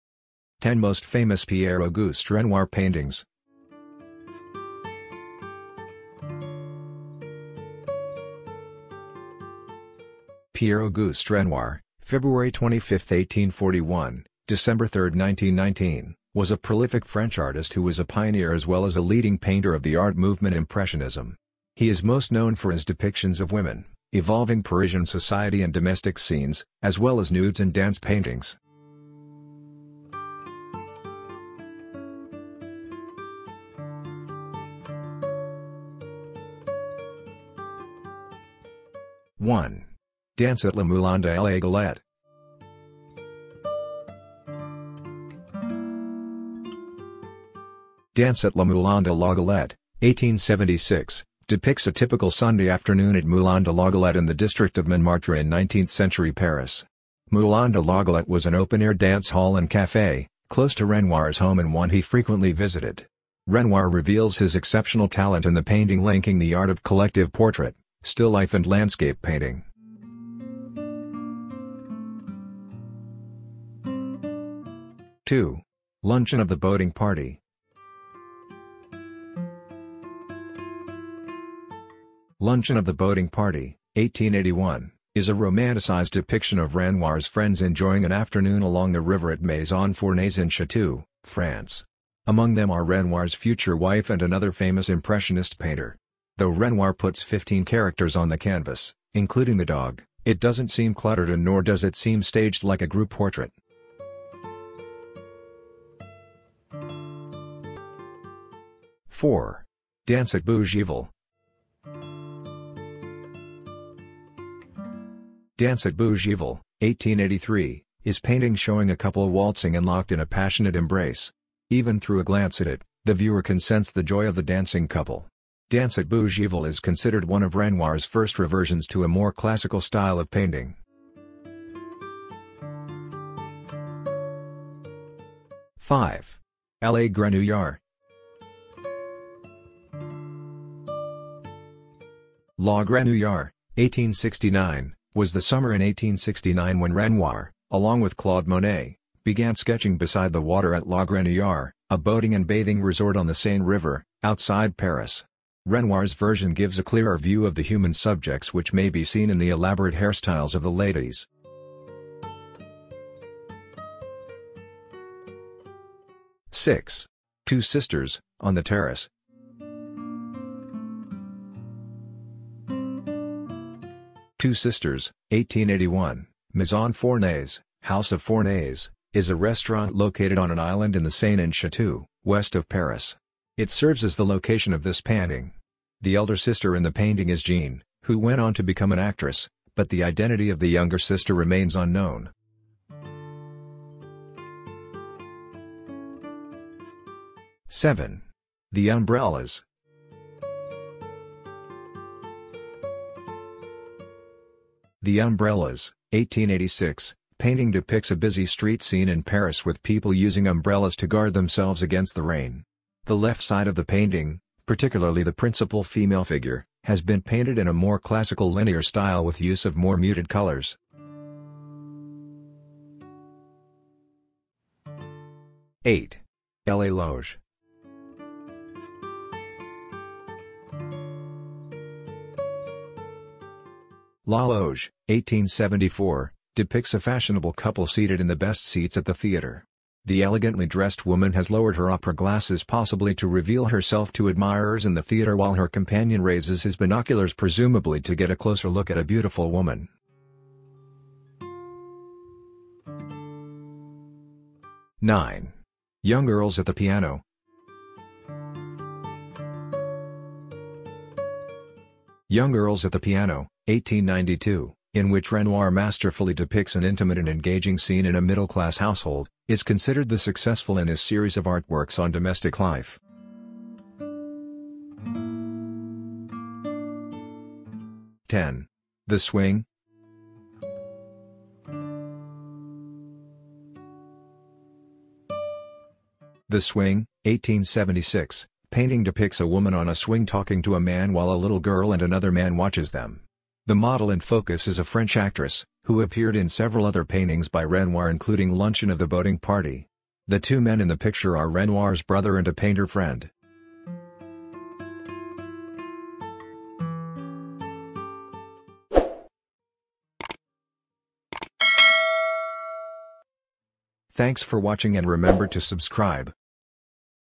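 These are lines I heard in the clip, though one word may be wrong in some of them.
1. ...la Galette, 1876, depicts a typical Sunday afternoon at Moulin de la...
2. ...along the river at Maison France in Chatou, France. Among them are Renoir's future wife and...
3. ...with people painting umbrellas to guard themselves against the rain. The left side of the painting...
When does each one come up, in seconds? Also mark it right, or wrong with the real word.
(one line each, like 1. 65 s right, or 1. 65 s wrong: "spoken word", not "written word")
1. 49 s right
2. 88 s wrong: "Fournaise", not "France"
3. 209 s wrong: "using", not "painting".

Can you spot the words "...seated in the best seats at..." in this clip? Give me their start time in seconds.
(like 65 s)
237 s.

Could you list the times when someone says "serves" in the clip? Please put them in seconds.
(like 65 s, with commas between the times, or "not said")
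183 s.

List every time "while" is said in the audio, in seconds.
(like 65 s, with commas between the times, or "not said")
245 s, 291 s.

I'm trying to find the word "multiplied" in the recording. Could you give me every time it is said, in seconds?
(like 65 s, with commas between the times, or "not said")
not said.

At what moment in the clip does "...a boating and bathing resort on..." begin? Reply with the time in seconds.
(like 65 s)
151 s.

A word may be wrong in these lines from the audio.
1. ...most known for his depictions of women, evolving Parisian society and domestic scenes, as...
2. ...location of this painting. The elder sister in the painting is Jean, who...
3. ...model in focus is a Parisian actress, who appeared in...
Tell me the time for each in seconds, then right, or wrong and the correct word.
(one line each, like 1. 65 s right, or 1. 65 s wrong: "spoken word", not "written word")
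1. 22 s right
2. 184 s right
3. 293 s wrong: "French", not "Parisian".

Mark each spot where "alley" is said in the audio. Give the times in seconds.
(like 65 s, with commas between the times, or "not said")
not said.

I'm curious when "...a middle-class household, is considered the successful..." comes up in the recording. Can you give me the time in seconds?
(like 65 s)
268 s.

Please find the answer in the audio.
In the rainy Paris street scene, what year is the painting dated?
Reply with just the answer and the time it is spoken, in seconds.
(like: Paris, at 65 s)
1886, at 206 s.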